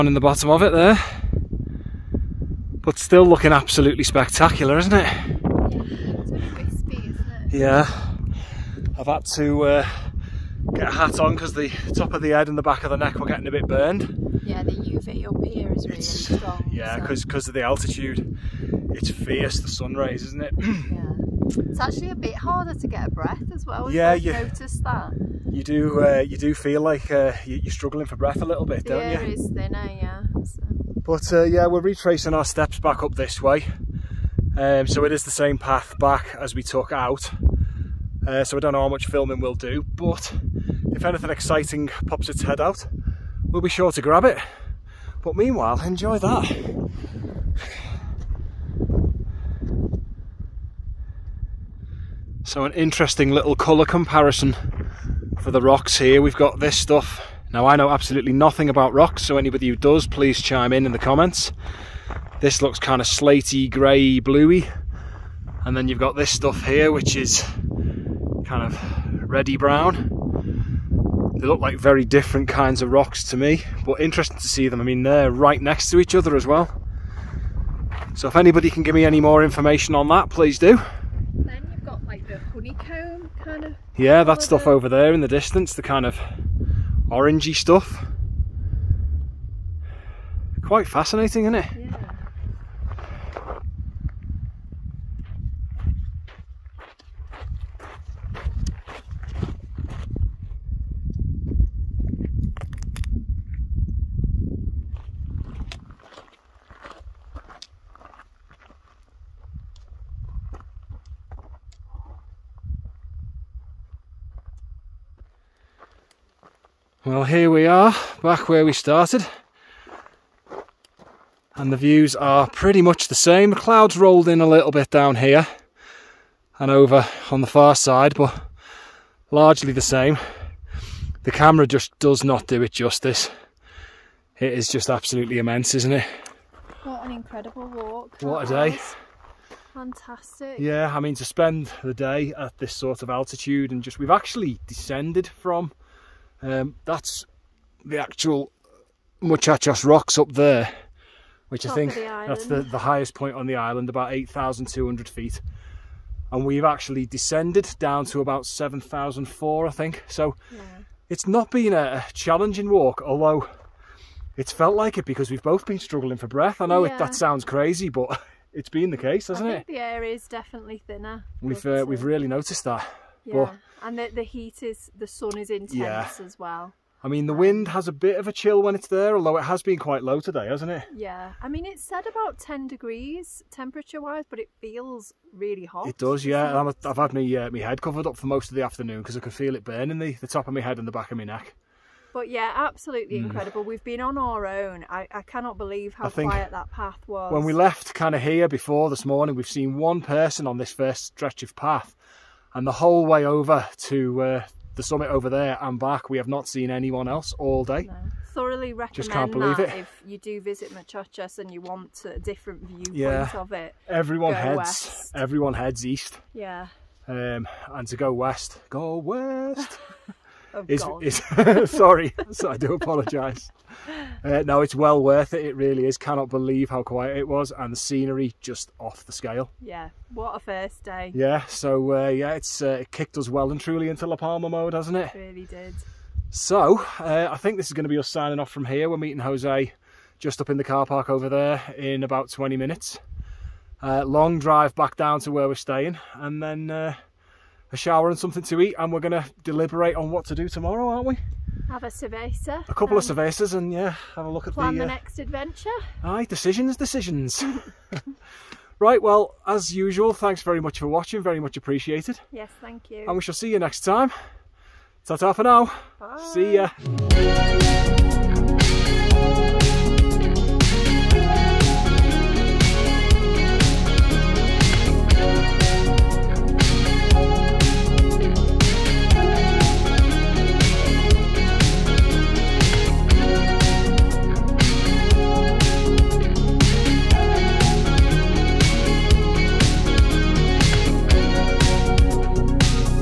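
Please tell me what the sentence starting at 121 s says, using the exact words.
And the views are pretty much the same.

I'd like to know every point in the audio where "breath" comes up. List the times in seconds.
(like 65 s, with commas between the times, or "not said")
23 s, 28 s, 166 s.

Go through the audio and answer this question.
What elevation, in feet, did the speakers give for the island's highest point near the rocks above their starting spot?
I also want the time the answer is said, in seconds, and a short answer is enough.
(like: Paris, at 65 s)
8,200 feet, at 154 s.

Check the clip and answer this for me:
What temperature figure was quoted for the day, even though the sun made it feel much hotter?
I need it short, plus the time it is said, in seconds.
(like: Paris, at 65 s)
10 degrees, at 182 s.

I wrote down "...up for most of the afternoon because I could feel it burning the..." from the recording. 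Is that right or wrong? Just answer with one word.
right.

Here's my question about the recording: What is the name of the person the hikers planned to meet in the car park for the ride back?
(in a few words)
Jose.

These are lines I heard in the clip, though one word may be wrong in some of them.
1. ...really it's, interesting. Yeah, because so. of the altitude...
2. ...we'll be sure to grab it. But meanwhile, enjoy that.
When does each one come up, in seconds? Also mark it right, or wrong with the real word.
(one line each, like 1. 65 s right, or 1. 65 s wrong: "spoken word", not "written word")
1. 15 s wrong: "strong", not "interesting"
2. 43 s right.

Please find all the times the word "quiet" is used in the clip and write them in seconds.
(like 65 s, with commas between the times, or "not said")
196 s, 226 s.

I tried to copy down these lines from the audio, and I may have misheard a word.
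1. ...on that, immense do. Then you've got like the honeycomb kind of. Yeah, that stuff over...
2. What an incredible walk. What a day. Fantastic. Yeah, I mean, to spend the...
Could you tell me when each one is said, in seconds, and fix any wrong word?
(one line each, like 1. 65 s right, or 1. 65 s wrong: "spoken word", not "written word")
1. 79 s wrong: "please", not "immense"
2. 136 s right.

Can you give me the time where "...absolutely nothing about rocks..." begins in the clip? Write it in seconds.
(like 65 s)
57 s.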